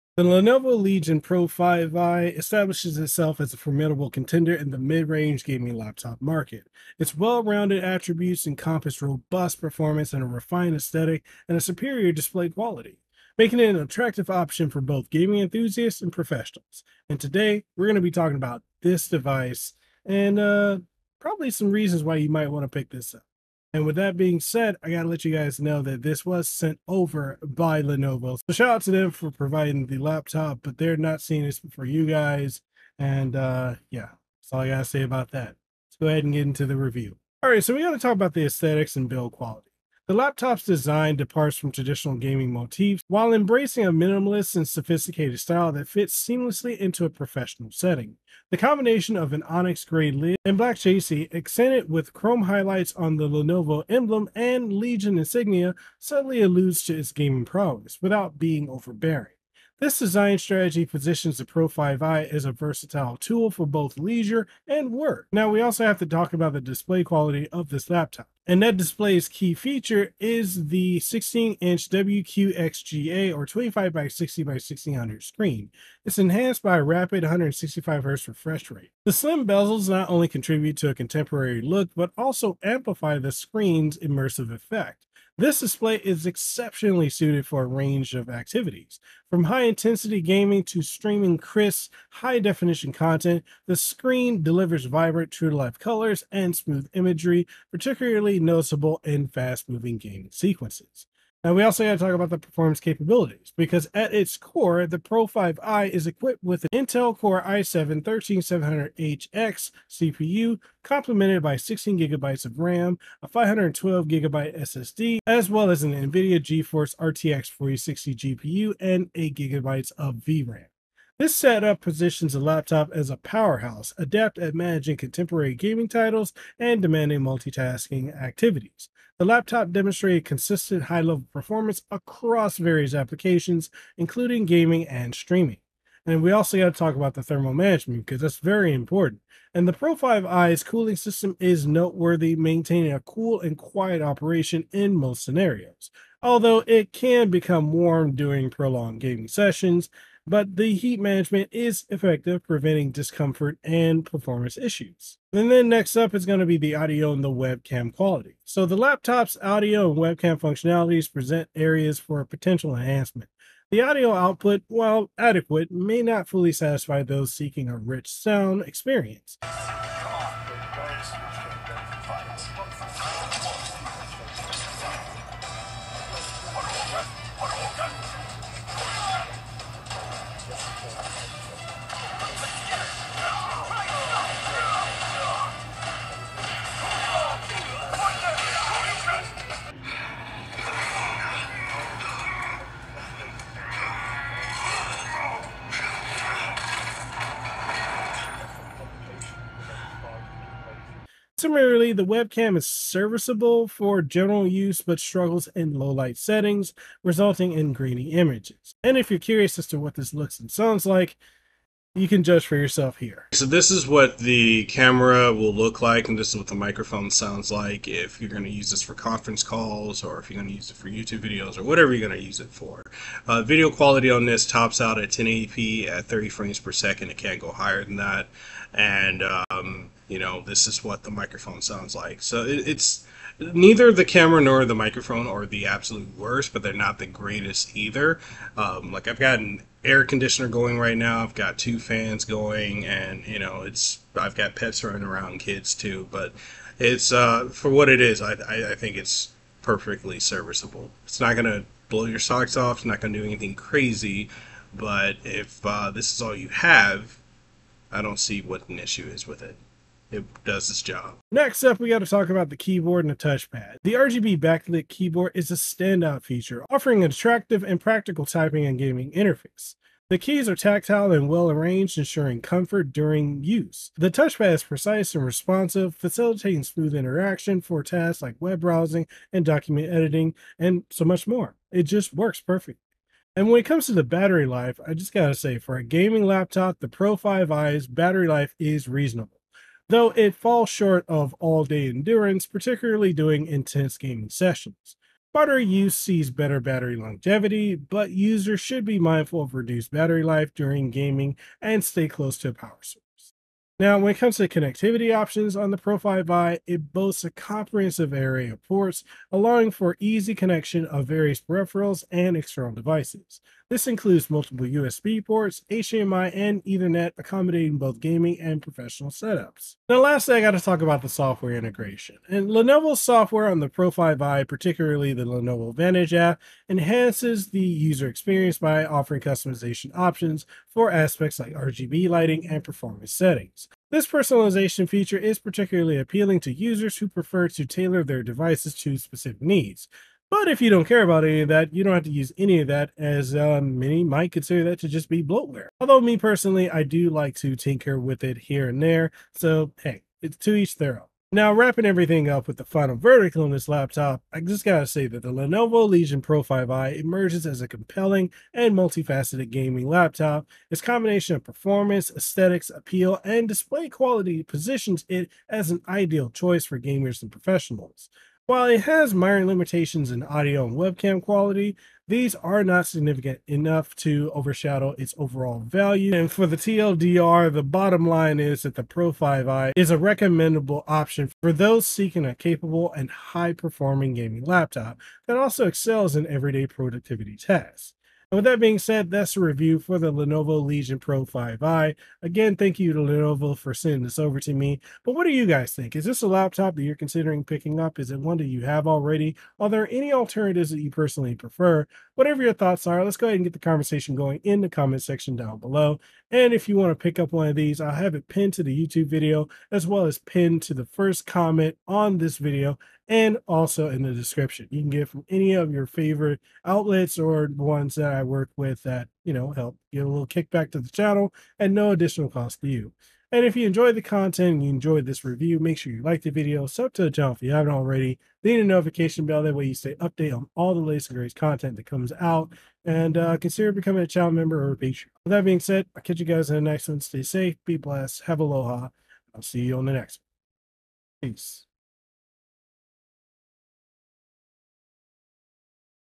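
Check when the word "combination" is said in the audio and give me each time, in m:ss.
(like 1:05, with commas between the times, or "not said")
0:48, 6:00.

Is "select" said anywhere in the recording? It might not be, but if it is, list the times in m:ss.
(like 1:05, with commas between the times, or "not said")
not said.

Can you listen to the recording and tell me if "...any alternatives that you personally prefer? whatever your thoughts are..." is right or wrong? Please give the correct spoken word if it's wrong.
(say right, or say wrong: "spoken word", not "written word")
right.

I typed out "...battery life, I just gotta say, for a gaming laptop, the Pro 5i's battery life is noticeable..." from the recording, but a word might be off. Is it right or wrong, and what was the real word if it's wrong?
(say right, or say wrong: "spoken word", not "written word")
wrong: "reasonable", not "noticeable".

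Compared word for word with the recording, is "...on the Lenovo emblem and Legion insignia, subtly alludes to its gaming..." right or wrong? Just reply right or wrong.
right.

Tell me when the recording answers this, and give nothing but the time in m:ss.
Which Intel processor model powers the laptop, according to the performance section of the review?
1:46.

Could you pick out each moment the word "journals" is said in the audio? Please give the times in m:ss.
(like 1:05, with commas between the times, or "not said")
not said.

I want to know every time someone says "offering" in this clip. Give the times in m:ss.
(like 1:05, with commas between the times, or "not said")
4:26, 5:28.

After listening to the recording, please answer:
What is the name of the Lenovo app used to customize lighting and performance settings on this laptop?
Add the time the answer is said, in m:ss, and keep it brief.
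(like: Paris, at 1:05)
Lenovo Vantage, at 5:25.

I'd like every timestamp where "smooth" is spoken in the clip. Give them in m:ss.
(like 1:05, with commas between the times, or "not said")
1:36, 4:36.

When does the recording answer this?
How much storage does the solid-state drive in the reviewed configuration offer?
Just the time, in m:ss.
1:53.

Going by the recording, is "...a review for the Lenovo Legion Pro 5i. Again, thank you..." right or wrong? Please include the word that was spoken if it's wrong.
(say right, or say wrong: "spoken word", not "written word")
right.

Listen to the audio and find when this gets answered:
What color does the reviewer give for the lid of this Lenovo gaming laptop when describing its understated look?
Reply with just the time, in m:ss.
0:49.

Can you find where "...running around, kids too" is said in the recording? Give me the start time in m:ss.
4:04.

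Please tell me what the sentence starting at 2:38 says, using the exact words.
So the laptop's audio and webcam functionalities present areas for potential enhancement.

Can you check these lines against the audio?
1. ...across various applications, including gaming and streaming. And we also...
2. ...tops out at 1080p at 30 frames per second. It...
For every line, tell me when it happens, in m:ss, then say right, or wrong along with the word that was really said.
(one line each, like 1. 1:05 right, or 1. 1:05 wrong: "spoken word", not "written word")
1. 2:11 right
2. 3:44 right.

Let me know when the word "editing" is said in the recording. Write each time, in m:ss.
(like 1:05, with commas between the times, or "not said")
4:39.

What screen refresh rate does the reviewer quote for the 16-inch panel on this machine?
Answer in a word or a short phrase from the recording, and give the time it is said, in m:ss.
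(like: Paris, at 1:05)
165Hz, at 1:17.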